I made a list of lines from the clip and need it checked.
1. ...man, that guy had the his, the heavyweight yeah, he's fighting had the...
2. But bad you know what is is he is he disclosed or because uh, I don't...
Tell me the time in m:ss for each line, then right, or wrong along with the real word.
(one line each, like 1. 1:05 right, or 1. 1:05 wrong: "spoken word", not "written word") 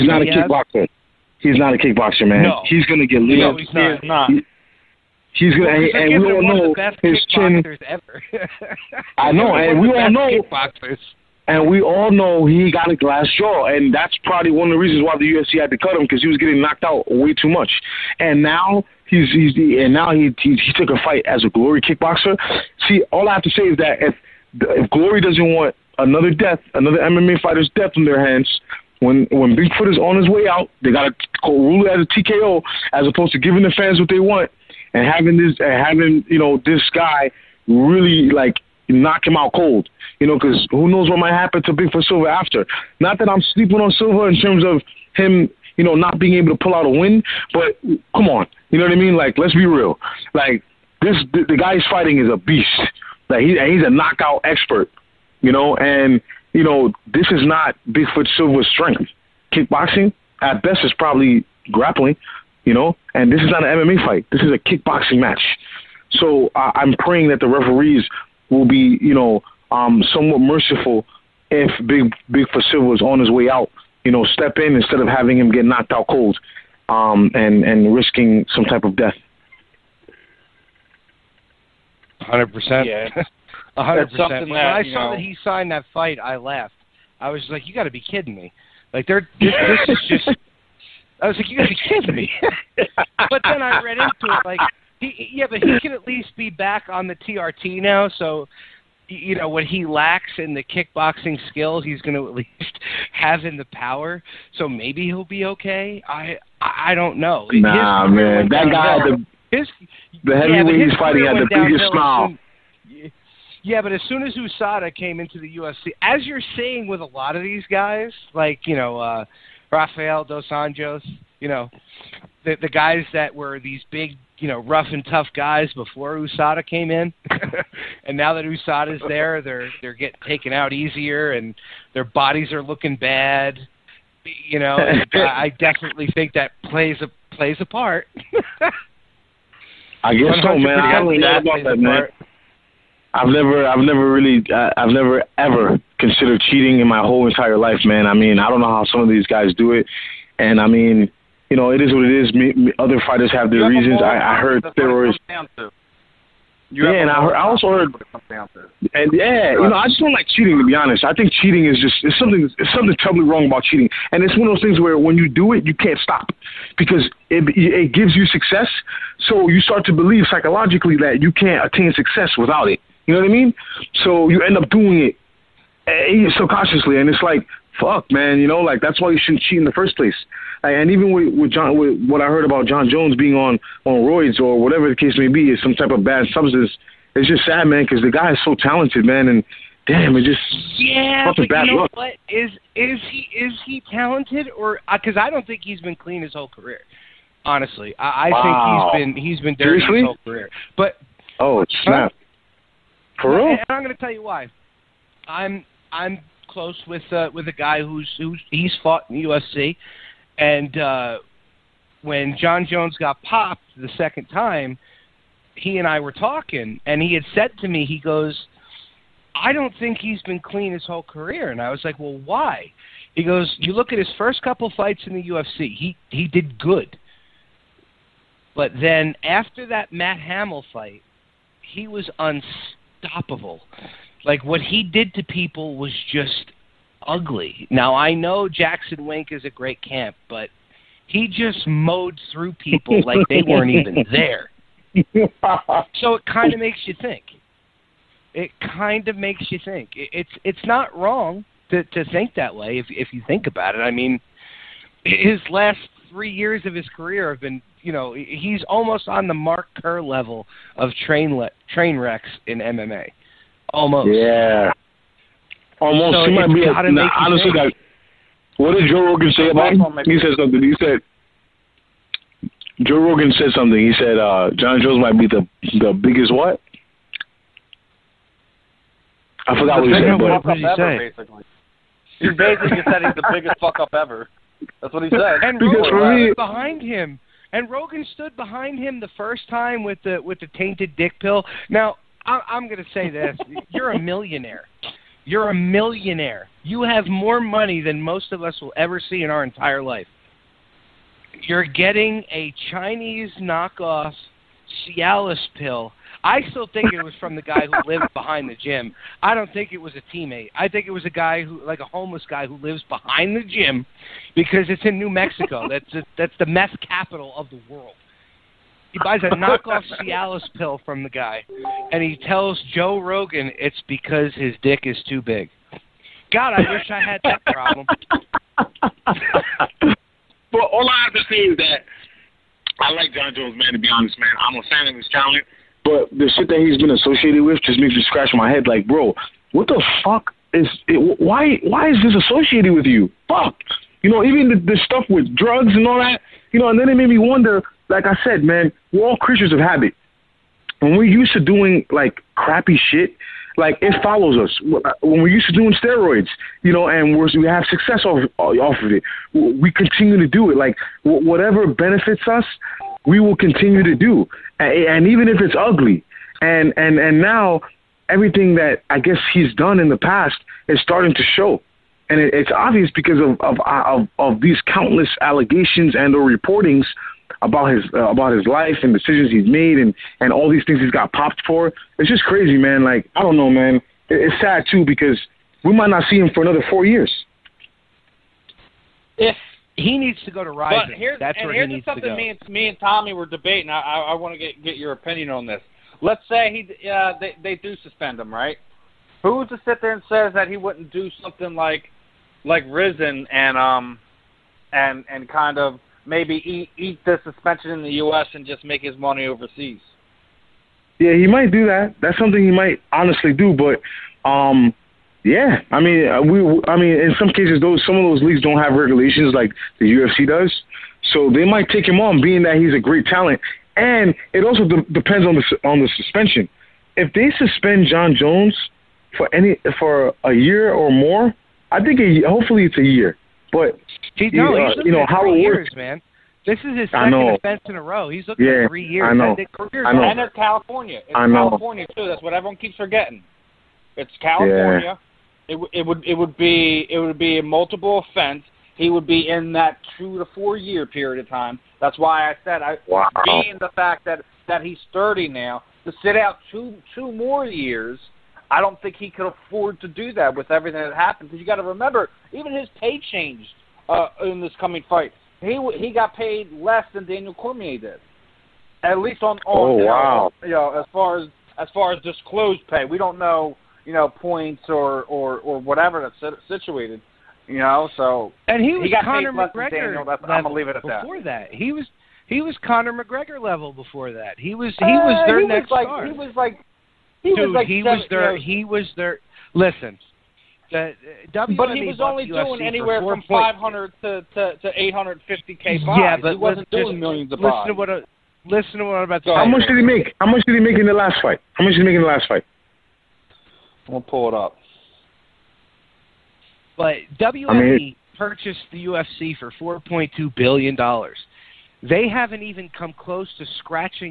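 1. 1:48 right
2. 3:11 wrong: "talented", not "disclosed".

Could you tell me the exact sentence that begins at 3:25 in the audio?
I'm I'm close with uh, with a guy who's who's he's fought in the UFC.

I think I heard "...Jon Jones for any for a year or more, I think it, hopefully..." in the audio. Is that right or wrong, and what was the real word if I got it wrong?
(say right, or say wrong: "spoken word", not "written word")
right.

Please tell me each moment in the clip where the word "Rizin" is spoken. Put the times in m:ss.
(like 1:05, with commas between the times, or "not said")
6:30, 6:42.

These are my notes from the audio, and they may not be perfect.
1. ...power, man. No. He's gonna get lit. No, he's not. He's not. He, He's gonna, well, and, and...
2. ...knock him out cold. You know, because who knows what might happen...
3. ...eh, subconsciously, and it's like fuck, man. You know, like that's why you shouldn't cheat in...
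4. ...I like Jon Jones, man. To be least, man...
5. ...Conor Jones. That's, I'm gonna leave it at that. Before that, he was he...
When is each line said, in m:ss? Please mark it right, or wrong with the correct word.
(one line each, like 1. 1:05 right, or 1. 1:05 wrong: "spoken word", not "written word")
1. 0:01 wrong: "kickboxer", not "power"
2. 0:38 right
3. 2:56 right
4. 5:32 wrong: "honest", not "least"
5. 7:59 wrong: "McGregor", not "Jones".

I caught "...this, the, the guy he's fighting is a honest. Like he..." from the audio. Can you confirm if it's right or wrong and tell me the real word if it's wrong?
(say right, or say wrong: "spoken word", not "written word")
wrong: "beast", not "honest".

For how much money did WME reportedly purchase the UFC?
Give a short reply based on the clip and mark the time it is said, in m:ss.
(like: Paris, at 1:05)
$4.2 billion, at 8:29.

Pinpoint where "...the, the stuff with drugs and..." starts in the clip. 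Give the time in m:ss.
5:44.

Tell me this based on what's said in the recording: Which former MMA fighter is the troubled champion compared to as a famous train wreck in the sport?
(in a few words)
Mark Kerr.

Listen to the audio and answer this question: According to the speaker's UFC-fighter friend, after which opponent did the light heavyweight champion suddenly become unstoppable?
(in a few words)
Matt Hamill.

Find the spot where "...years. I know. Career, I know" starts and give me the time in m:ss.
7:18.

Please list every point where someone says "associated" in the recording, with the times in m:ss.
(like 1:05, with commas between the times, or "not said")
5:36, 5:42.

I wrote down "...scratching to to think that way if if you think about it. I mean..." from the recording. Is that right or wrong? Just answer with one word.
wrong.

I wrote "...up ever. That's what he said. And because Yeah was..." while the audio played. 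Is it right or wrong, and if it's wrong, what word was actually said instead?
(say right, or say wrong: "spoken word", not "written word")
wrong: "Rogan", not "Yeah".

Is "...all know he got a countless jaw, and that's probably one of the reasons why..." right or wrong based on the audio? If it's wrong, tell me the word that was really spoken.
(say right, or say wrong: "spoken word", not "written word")
wrong: "glass", not "countless".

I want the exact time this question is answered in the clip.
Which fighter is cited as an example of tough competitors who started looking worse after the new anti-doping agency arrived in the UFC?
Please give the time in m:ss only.
1:59.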